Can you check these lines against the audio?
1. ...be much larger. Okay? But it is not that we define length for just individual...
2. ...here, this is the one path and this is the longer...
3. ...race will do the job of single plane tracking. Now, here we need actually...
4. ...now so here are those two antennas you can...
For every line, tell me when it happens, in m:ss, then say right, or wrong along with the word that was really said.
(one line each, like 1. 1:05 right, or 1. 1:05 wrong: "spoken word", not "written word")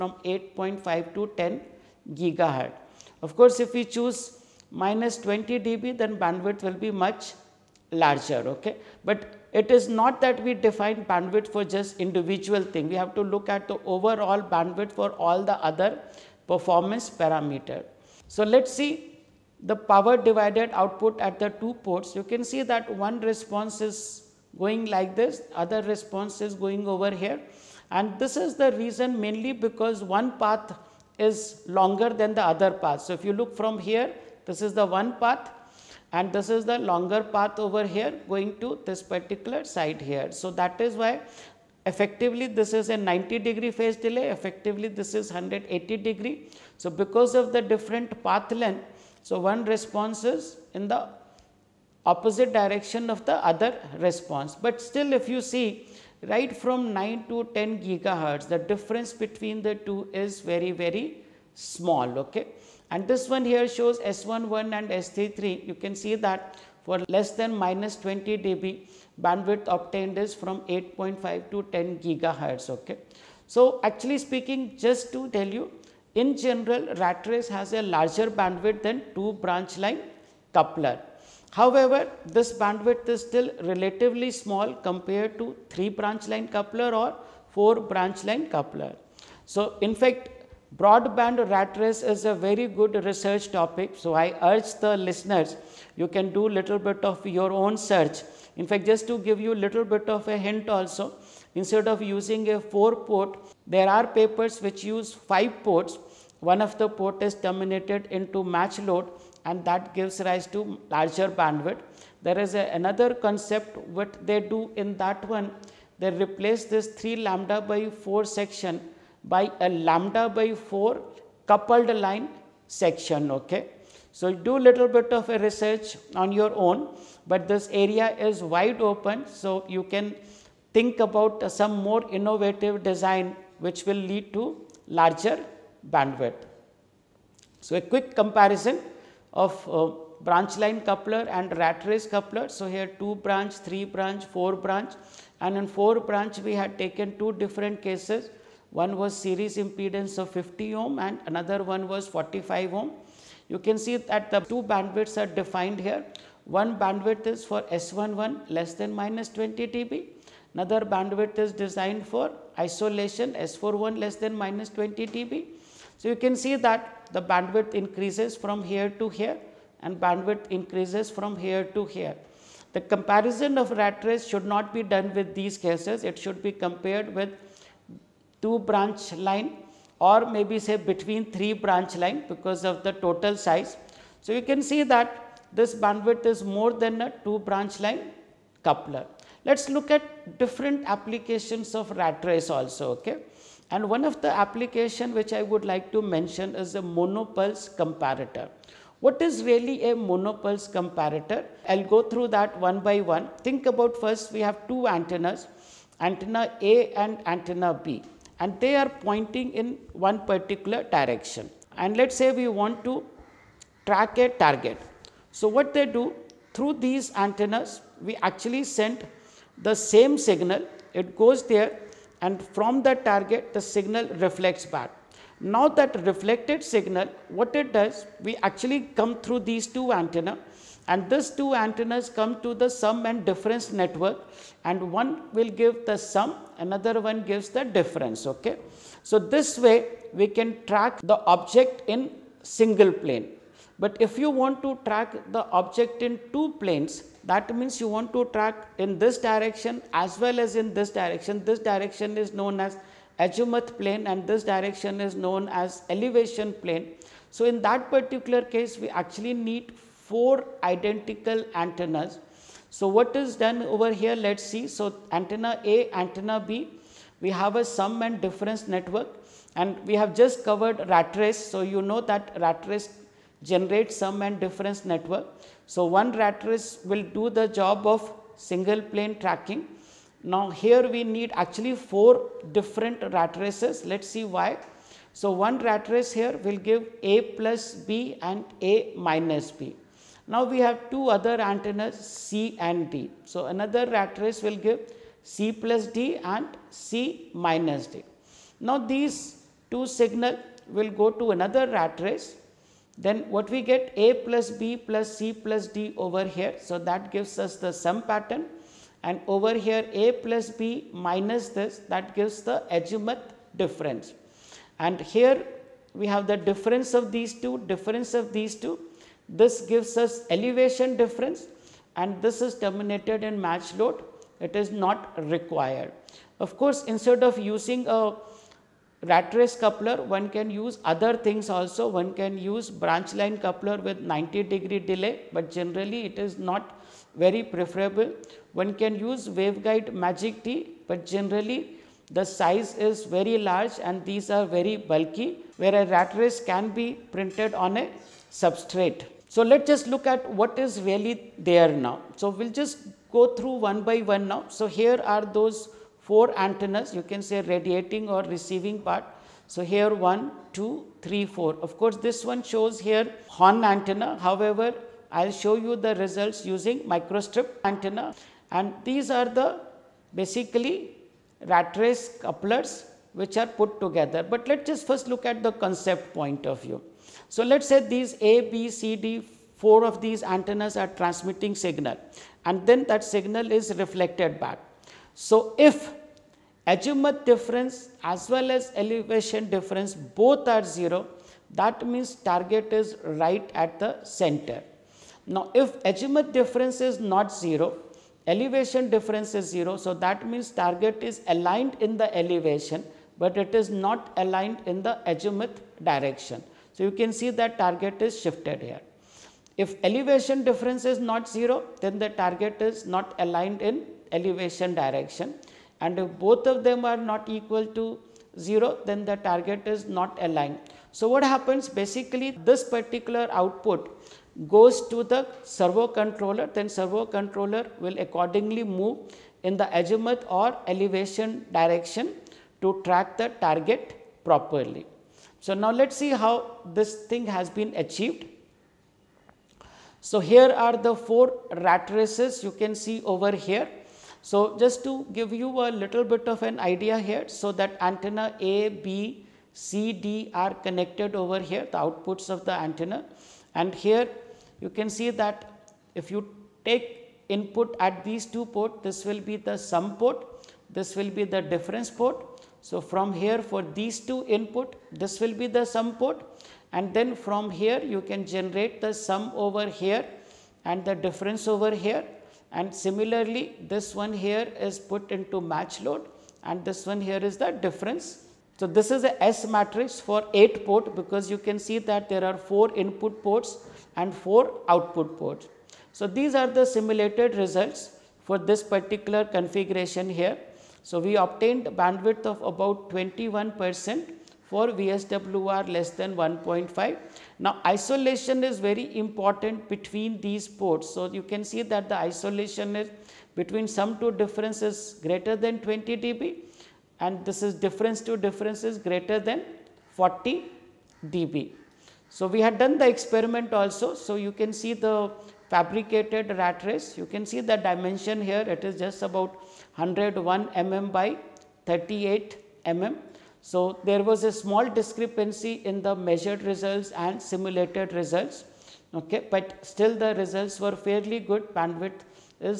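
1. 0:06 wrong: "bandwidth", not "length"
2. 0:33 right
3. 4:36 right
4. 5:54 wrong: "four", not "two".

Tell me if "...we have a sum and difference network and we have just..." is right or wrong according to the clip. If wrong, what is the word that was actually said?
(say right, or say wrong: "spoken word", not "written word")
right.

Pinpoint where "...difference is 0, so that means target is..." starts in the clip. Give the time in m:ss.
6:38.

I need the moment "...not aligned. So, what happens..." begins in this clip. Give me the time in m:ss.
6:59.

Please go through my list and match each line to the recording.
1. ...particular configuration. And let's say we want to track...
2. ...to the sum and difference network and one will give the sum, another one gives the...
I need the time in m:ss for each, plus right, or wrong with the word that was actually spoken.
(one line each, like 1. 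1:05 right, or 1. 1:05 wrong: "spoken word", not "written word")
1. 3:30 wrong: "direction", not "configuration"
2. 3:52 right.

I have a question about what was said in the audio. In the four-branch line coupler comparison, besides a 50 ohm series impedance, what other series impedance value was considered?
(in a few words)
45 ohm.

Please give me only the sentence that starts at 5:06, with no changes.
So, that gives us the sum pattern and over here A plus B minus this that gives the azimuth difference.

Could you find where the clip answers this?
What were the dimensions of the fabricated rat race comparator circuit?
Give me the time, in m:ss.
8:39.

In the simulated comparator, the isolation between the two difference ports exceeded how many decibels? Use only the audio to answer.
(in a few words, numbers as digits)
40 dB.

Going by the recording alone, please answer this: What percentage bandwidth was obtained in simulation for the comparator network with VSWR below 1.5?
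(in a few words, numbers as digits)
21 percent.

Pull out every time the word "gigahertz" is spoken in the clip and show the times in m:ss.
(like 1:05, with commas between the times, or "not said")
0:02, 0:57, 1:12.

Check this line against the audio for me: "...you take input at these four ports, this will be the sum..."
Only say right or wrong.
wrong.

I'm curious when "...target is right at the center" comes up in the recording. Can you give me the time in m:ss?
6:32.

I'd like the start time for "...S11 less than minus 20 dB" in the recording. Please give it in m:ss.
2:37.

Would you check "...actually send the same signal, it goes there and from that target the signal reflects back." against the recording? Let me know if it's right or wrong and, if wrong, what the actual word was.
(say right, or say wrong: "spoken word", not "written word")
right.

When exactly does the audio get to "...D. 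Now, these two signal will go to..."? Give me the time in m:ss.
4:57.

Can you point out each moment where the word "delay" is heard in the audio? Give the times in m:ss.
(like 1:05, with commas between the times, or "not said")
0:43, 5:34.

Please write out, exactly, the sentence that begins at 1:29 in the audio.
So, in fact, broadband rat race is a very good research topic.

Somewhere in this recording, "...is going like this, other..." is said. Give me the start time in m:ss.
0:23.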